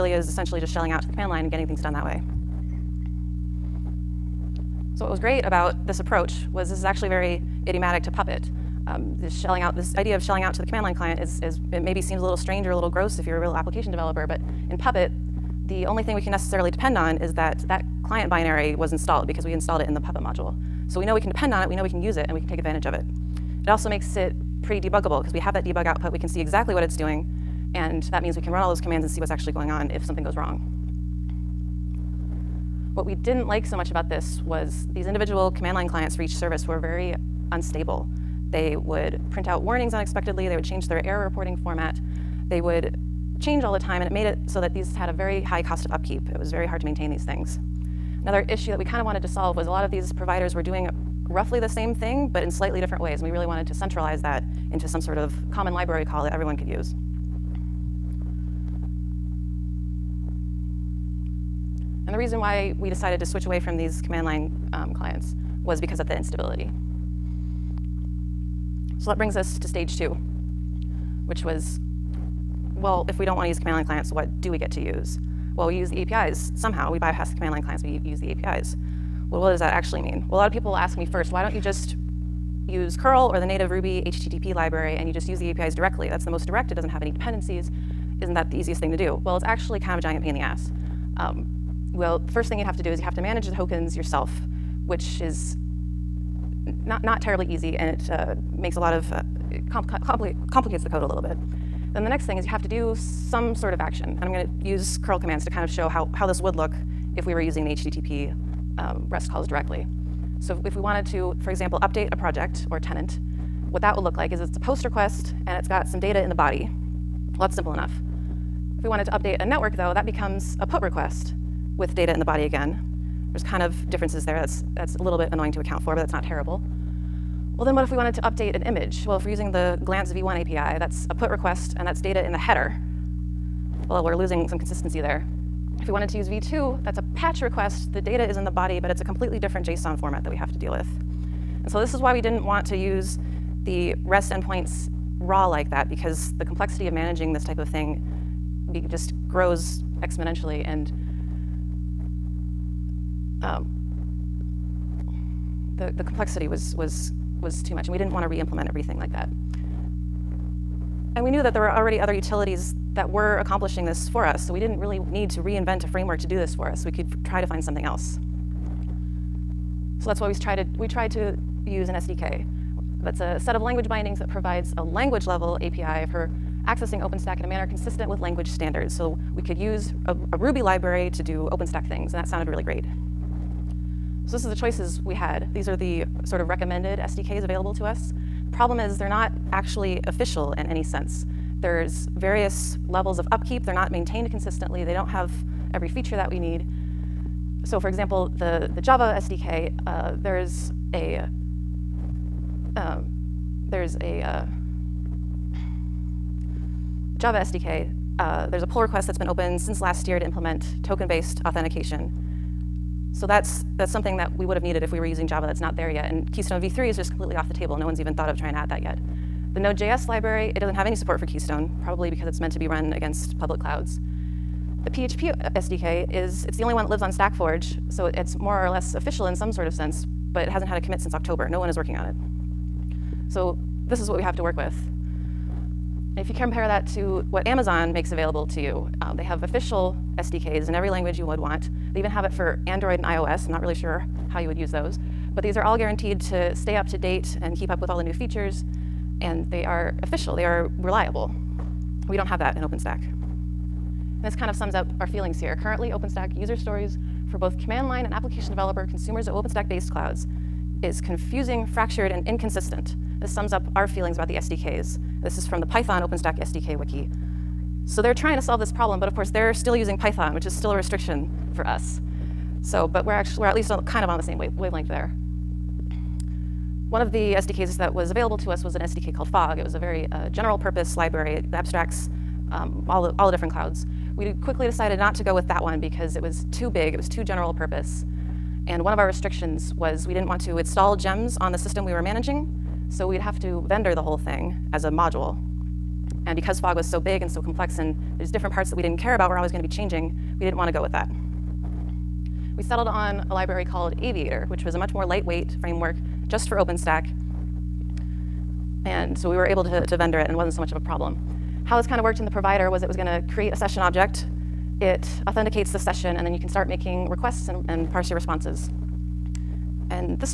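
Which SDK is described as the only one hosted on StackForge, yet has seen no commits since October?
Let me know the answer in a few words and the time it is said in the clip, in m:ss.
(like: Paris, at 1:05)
PHP SDK, at 3:44.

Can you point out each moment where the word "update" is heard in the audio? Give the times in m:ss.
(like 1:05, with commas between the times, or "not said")
1:51, 1:59, 2:08.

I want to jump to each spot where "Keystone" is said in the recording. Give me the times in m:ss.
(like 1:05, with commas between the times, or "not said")
3:36, 3:41.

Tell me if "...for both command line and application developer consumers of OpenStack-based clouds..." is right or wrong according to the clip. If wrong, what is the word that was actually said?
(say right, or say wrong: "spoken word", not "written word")
right.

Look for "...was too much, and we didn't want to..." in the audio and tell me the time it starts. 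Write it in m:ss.
2:37.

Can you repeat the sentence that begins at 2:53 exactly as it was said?
That's a set of language bindings that provides a language level API for accessing OpenStack in a manner consistent with language standards.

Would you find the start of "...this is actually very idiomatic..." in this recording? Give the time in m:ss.
0:06.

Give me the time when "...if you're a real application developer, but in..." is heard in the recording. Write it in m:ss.
0:13.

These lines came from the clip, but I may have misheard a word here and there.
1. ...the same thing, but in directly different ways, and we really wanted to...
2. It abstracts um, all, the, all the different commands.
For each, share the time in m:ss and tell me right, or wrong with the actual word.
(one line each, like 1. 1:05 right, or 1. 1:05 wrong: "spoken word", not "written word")
1. 0:51 wrong: "slightly", not "directly"
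2. 4:41 wrong: "clouds", not "commands".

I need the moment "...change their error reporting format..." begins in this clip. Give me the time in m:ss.
0:40.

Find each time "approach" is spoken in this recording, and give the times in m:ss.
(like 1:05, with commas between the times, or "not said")
0:05.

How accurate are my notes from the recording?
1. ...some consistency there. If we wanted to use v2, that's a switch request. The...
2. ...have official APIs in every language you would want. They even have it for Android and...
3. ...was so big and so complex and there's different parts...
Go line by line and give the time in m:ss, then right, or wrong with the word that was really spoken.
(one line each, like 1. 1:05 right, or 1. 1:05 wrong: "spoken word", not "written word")
1. 2:14 wrong: "patch", not "switch"
2. 3:59 wrong: "SDKs", not "APIs"
3. 4:56 right.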